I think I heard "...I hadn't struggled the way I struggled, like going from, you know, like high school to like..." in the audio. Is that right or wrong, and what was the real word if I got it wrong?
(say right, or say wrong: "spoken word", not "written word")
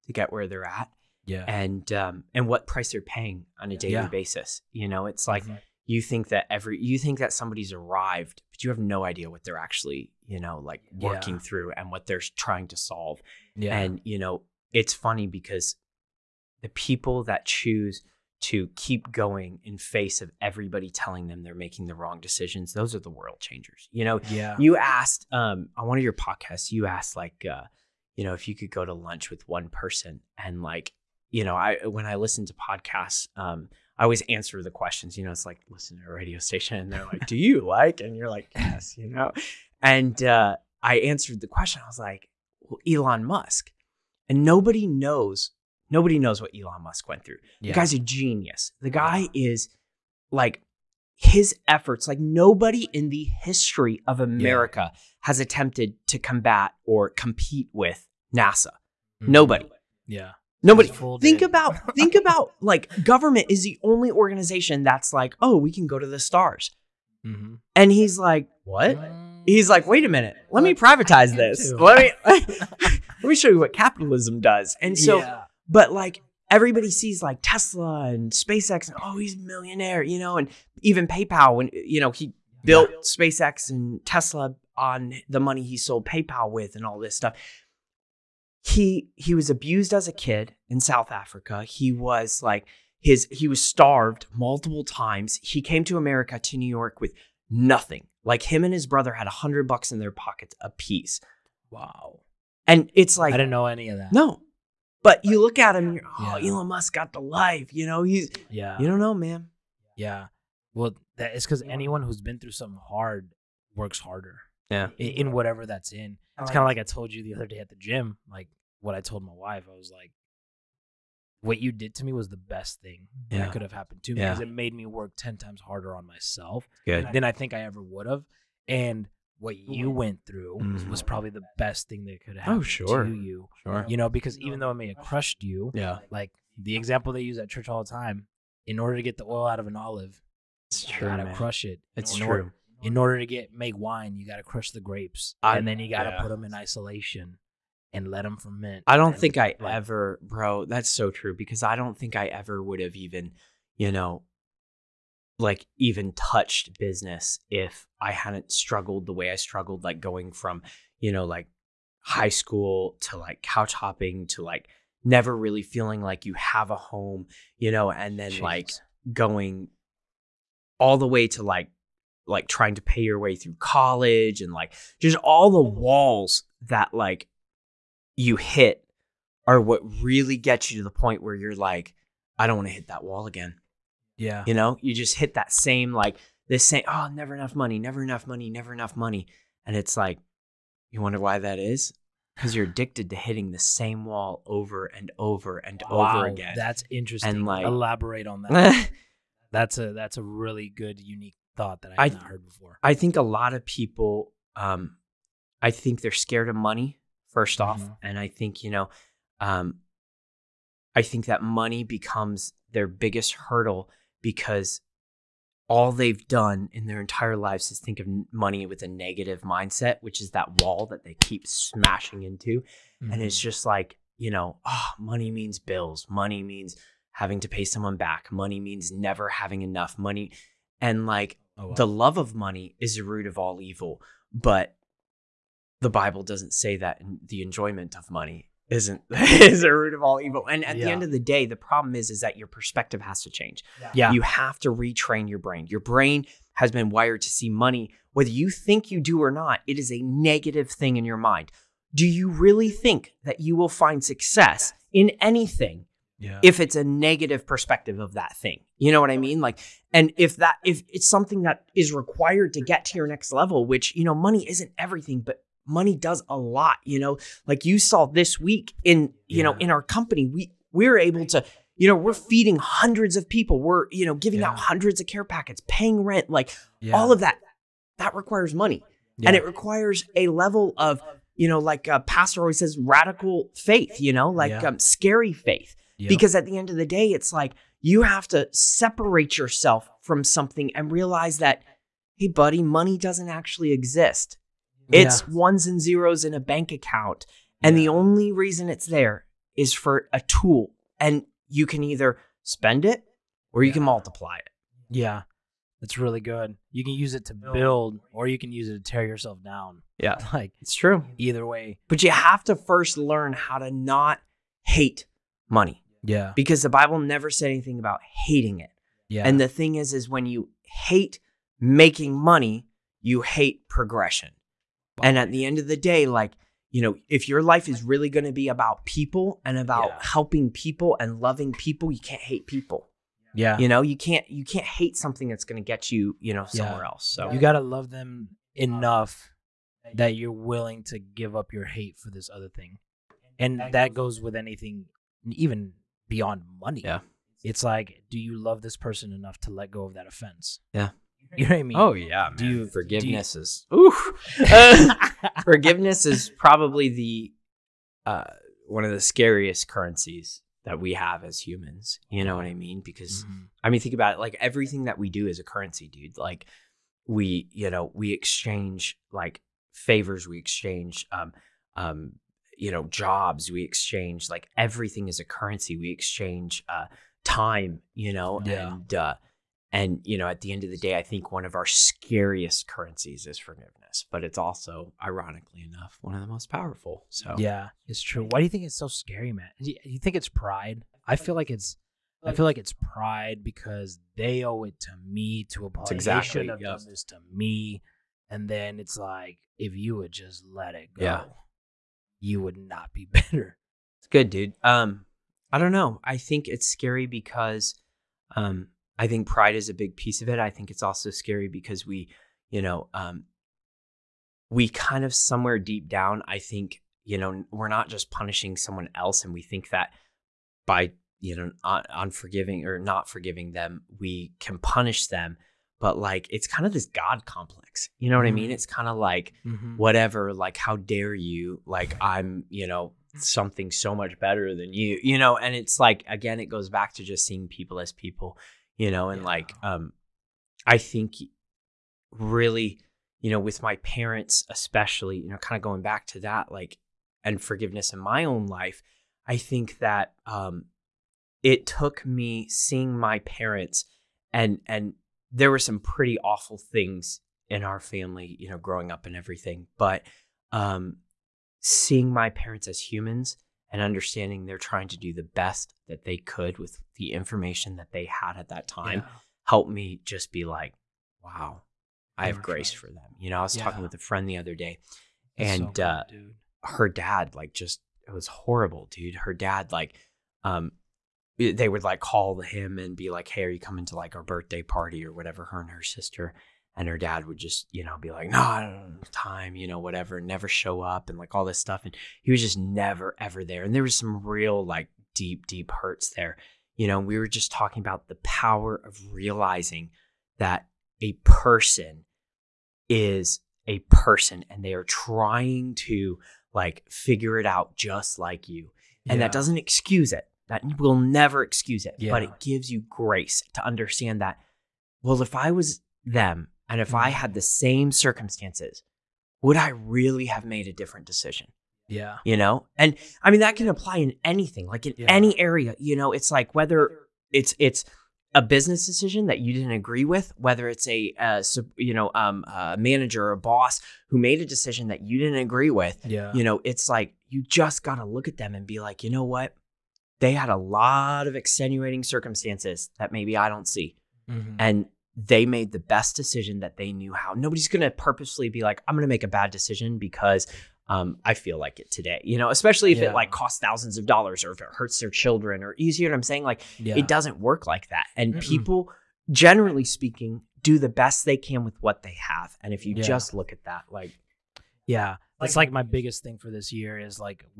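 right.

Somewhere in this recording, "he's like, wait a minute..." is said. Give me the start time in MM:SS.
01:09.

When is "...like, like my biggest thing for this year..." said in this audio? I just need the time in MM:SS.
09:25.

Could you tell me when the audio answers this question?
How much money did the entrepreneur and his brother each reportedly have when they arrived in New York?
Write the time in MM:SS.
01:39.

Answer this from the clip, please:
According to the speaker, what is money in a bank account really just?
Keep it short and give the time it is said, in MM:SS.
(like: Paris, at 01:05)
ones and zeros, at 04:55.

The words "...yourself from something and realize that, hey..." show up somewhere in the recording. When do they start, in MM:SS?
04:49.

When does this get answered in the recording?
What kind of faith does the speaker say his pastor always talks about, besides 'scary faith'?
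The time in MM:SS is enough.
04:42.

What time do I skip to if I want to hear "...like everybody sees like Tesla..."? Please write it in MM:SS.
01:15.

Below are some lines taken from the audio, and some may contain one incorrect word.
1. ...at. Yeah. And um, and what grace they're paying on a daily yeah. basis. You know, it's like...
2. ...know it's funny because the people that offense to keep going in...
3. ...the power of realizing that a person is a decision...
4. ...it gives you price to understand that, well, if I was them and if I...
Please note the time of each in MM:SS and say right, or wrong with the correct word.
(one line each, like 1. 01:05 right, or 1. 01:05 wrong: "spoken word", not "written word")
1. 00:00 wrong: "price", not "grace"
2. 00:14 wrong: "choose", not "offense"
3. 08:18 wrong: "person", not "decision"
4. 08:32 wrong: "grace", not "price".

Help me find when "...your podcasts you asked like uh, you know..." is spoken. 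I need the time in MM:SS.
00:26.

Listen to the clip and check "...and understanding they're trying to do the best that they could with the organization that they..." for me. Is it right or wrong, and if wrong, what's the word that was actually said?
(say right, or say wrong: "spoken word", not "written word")
wrong: "information", not "organization".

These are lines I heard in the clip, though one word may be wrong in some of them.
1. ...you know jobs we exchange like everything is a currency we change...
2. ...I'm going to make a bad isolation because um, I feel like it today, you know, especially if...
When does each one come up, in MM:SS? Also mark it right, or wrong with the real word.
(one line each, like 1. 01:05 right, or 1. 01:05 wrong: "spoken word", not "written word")
1. 06:12 wrong: "exchange", not "change"
2. 09:08 wrong: "decision", not "isolation".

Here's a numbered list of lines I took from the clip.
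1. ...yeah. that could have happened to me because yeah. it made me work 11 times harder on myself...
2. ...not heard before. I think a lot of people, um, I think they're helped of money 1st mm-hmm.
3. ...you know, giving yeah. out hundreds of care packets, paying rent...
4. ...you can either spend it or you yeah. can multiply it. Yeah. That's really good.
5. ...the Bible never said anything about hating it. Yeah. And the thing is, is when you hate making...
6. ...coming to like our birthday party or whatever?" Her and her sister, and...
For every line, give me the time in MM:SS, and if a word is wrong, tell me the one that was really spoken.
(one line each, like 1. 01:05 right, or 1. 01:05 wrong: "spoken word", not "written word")
1. 02:03 wrong: "10", not "11"
2. 03:22 wrong: "scared", not "helped"
3. 04:33 right
4. 05:01 right
5. 05:16 right
6. 08:03 right.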